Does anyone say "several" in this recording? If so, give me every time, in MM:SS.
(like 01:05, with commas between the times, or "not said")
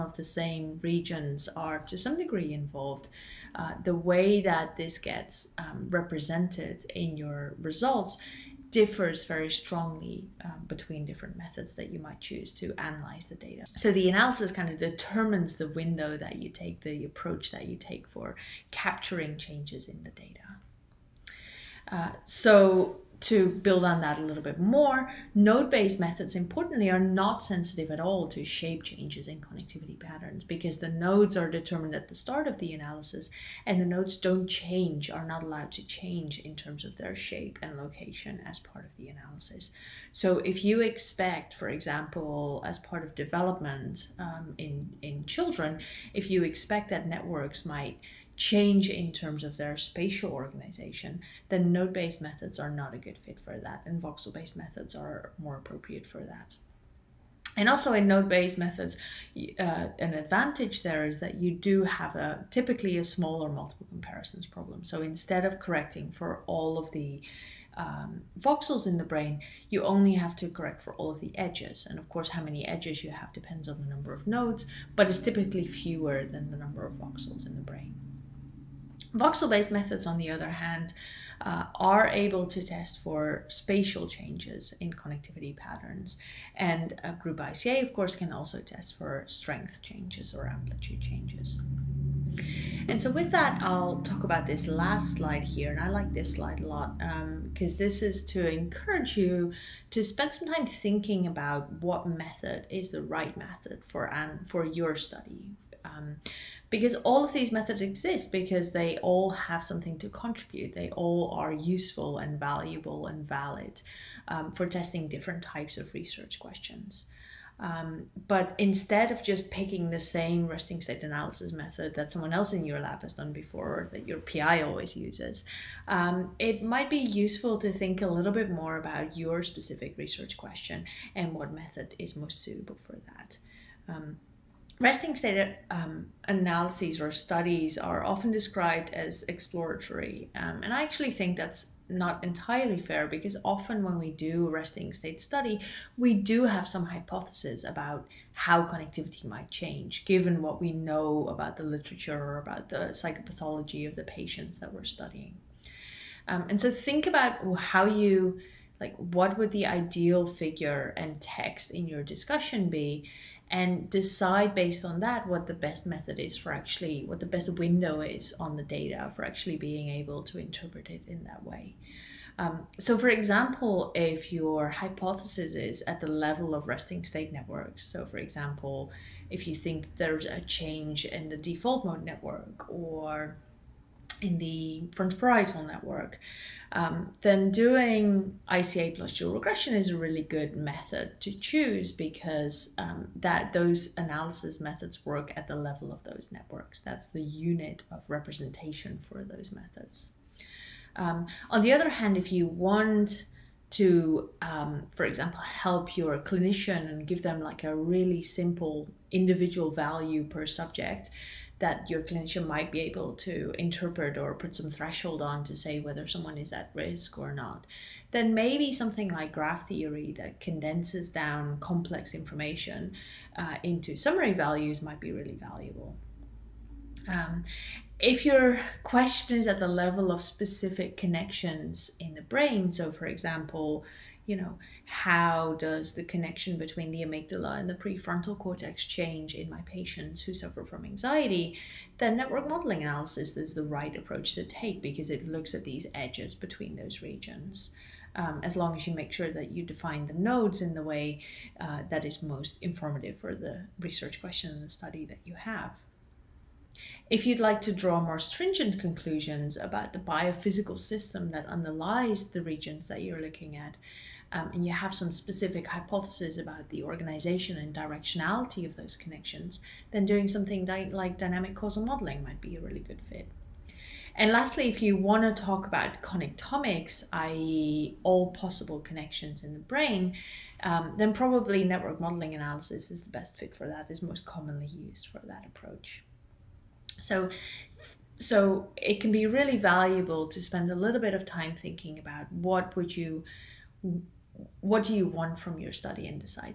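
not said.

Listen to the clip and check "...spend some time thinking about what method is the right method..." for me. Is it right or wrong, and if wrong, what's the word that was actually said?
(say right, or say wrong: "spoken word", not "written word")
right.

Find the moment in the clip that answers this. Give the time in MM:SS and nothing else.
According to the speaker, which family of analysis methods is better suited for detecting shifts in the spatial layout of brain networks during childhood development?
00:54.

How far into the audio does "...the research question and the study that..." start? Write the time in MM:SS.
04:13.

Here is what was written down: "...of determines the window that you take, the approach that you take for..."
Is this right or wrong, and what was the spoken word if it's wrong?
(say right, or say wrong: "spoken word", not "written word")
right.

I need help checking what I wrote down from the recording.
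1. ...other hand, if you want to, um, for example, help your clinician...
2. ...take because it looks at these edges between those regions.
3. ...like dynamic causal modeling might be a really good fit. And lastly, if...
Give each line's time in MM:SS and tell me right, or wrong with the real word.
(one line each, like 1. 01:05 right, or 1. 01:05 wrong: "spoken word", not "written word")
1. 03:21 right
2. 04:04 right
3. 04:30 right.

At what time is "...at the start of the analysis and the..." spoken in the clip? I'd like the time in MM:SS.
00:31.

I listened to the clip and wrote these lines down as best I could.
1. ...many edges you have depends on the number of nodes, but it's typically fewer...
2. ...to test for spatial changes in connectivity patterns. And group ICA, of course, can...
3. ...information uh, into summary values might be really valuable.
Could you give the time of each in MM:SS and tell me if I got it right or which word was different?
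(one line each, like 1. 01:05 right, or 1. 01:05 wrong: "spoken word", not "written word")
1. 01:12 right
2. 01:22 right
3. 03:42 right.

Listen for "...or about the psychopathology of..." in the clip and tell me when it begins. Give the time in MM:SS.
02:32.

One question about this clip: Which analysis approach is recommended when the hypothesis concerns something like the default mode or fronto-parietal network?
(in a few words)
ICA plus dual regression.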